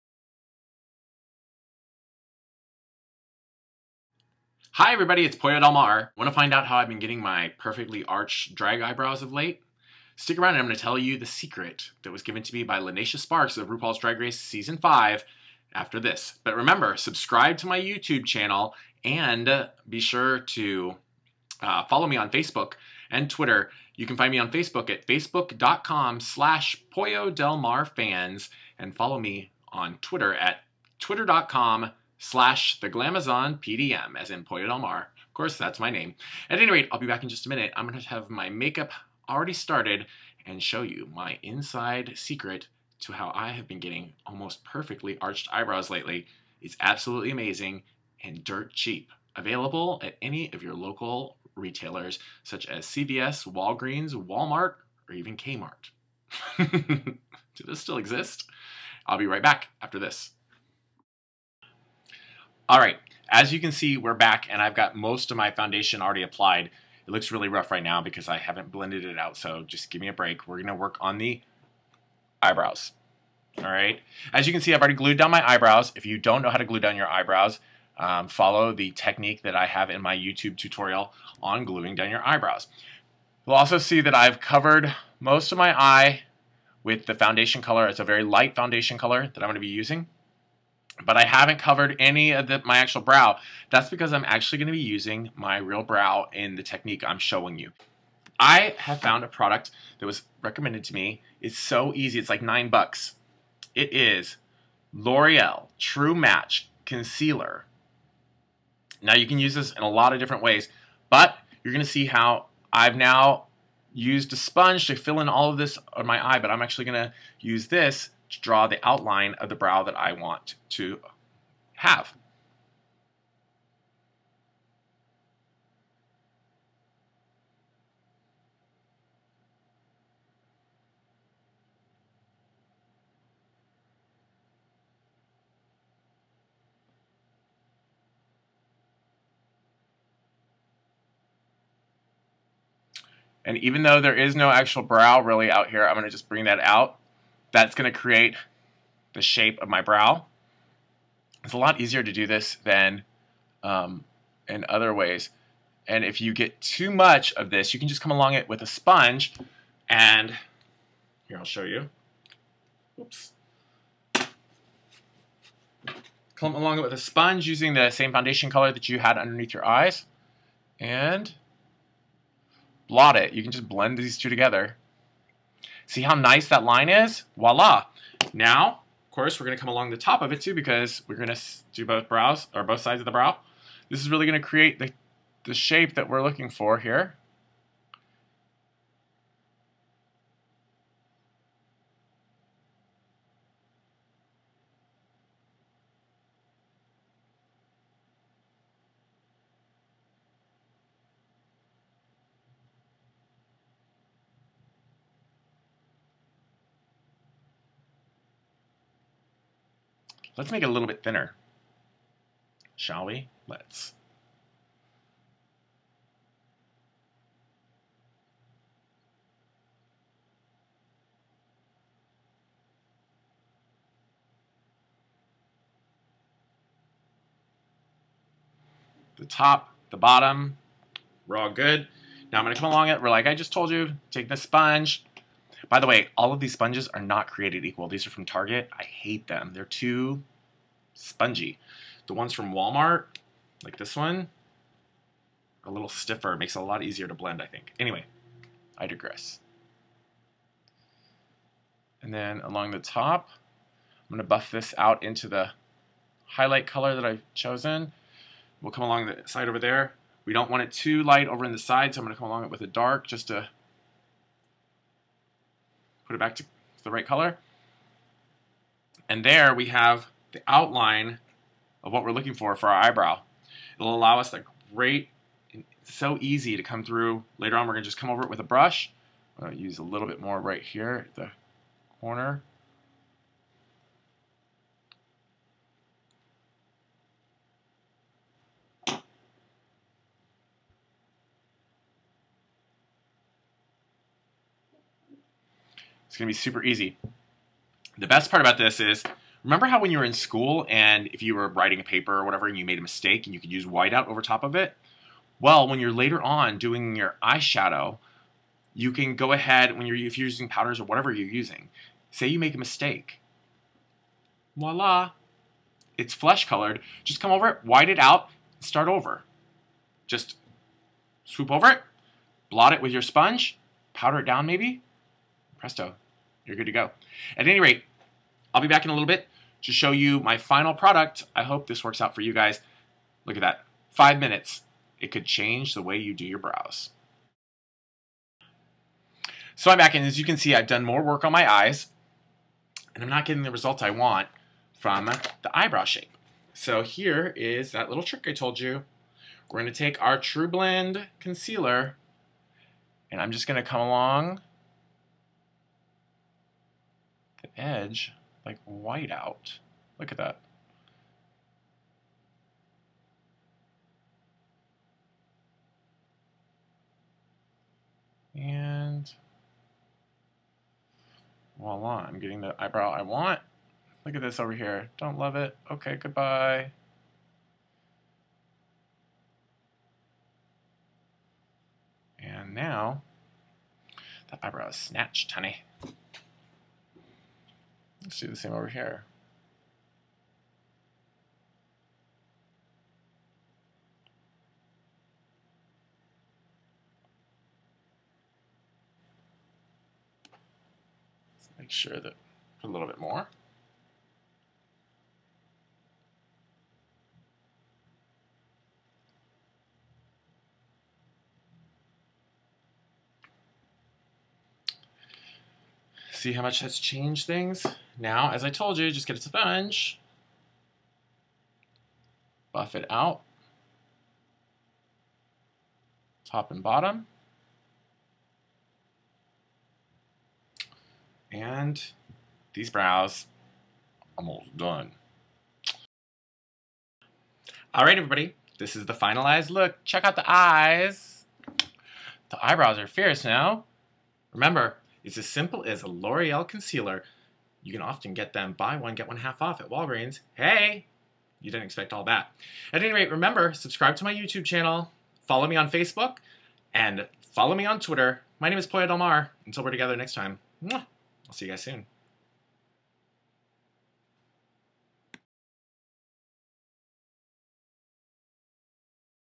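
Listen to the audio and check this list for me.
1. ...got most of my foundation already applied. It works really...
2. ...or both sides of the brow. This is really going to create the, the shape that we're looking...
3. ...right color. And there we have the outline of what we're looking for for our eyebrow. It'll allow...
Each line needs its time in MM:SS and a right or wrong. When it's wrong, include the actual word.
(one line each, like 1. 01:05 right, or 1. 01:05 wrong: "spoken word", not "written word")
1. 01:04 wrong: "looks", not "works"
2. 03:02 right
3. 04:26 right.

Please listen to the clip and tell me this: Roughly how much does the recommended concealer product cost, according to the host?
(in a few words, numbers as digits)
9 dollars.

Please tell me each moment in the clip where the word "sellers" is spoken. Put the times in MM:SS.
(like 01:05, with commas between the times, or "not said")
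not said.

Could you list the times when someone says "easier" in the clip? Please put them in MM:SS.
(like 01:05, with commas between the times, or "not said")
02:31, 04:06.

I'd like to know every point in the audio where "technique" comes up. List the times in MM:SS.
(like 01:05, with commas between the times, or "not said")
01:18, 01:36.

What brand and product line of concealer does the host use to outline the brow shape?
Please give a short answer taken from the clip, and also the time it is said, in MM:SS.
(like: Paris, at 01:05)
L'Oreal True Match, at 01:44.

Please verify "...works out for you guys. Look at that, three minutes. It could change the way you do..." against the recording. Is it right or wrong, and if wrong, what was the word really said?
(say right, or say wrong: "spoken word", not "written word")
wrong: "five", not "three".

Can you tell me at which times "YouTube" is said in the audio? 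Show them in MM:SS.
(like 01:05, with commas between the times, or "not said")
00:17, 01:20, 07:34.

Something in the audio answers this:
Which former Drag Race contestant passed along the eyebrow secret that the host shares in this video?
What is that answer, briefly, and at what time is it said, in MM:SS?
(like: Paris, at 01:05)
Lineysha Sparx, at 00:12.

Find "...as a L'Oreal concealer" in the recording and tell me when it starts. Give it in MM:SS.
07:25.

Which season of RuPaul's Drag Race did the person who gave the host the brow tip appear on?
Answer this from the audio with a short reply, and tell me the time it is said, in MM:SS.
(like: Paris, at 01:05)
Season 5, at 00:14.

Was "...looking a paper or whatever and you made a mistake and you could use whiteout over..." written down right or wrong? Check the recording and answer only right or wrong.
wrong.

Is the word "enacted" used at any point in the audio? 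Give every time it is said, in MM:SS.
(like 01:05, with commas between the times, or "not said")
not said.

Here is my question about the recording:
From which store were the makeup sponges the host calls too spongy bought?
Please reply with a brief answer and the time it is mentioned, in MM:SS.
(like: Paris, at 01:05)
Target, at 03:58.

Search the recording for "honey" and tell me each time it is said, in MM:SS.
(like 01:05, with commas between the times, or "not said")
06:25.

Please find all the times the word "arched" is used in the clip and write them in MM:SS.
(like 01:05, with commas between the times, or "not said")
00:08, 00:45.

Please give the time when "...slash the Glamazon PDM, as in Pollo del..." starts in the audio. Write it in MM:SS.
00:32.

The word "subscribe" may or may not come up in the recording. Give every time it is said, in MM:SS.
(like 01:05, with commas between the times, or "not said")
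00:16, 07:33.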